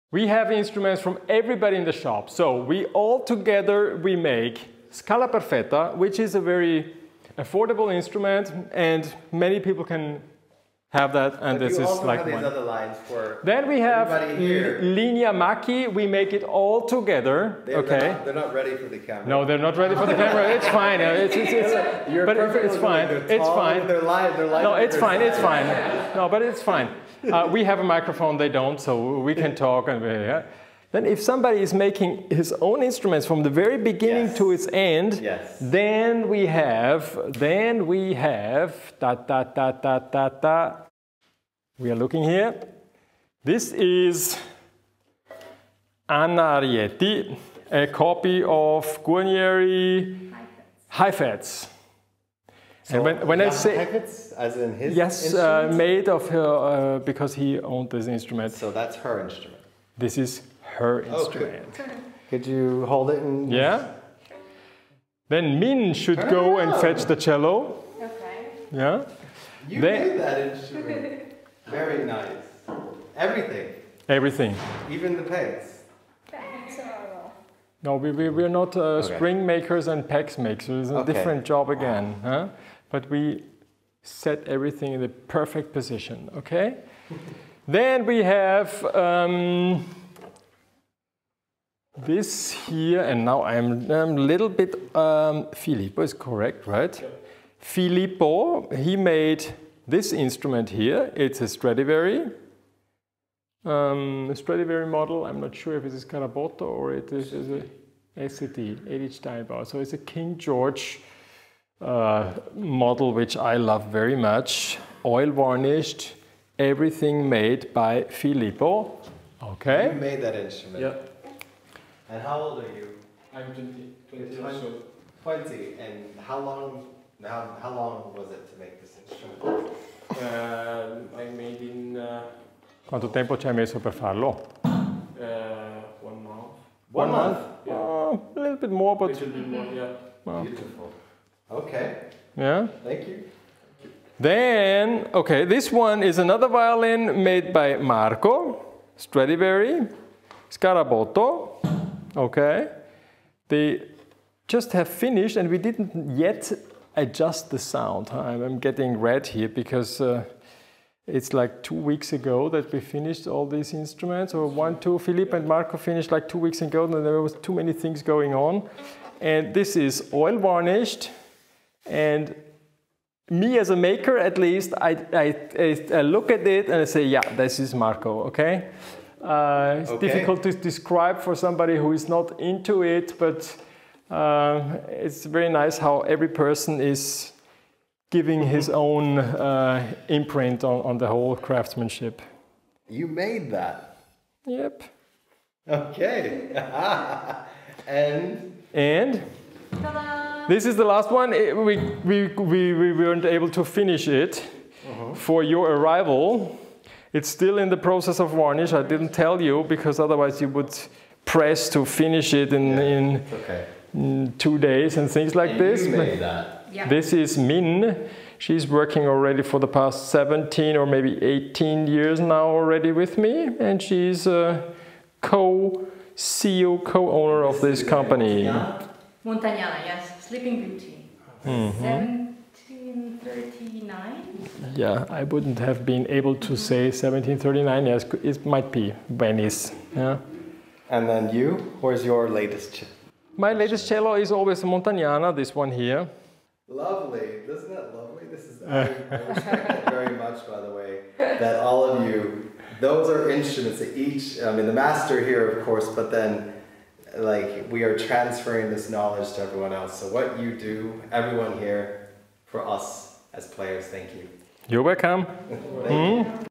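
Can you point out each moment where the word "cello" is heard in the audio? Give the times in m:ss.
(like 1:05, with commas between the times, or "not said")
1:07, 4:03.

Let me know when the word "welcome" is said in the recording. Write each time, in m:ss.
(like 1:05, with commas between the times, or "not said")
4:24.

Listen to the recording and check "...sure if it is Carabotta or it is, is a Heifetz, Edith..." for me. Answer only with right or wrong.
wrong.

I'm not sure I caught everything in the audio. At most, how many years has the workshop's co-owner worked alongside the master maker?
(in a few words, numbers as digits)
18 years.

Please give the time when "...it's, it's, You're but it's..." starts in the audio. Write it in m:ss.
0:21.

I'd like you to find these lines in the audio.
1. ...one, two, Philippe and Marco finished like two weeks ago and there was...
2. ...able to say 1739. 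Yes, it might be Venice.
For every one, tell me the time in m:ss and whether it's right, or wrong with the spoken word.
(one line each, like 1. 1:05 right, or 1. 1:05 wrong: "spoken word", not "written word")
1. 2:44 right
2. 3:56 right.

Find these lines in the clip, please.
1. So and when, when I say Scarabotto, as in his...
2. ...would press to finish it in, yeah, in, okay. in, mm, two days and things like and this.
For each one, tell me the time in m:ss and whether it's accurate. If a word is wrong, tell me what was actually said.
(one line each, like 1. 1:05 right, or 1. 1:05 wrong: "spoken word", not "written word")
1. 0:52 wrong: "Heifetz", not "Scarabotto"
2. 3:30 right.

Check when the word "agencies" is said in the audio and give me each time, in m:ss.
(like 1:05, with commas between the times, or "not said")
not said.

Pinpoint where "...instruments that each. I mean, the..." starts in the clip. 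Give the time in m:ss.
4:13.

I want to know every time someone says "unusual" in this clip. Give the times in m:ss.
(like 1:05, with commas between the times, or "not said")
not said.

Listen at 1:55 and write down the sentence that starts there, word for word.
Oil varnished, everything made by Filippo.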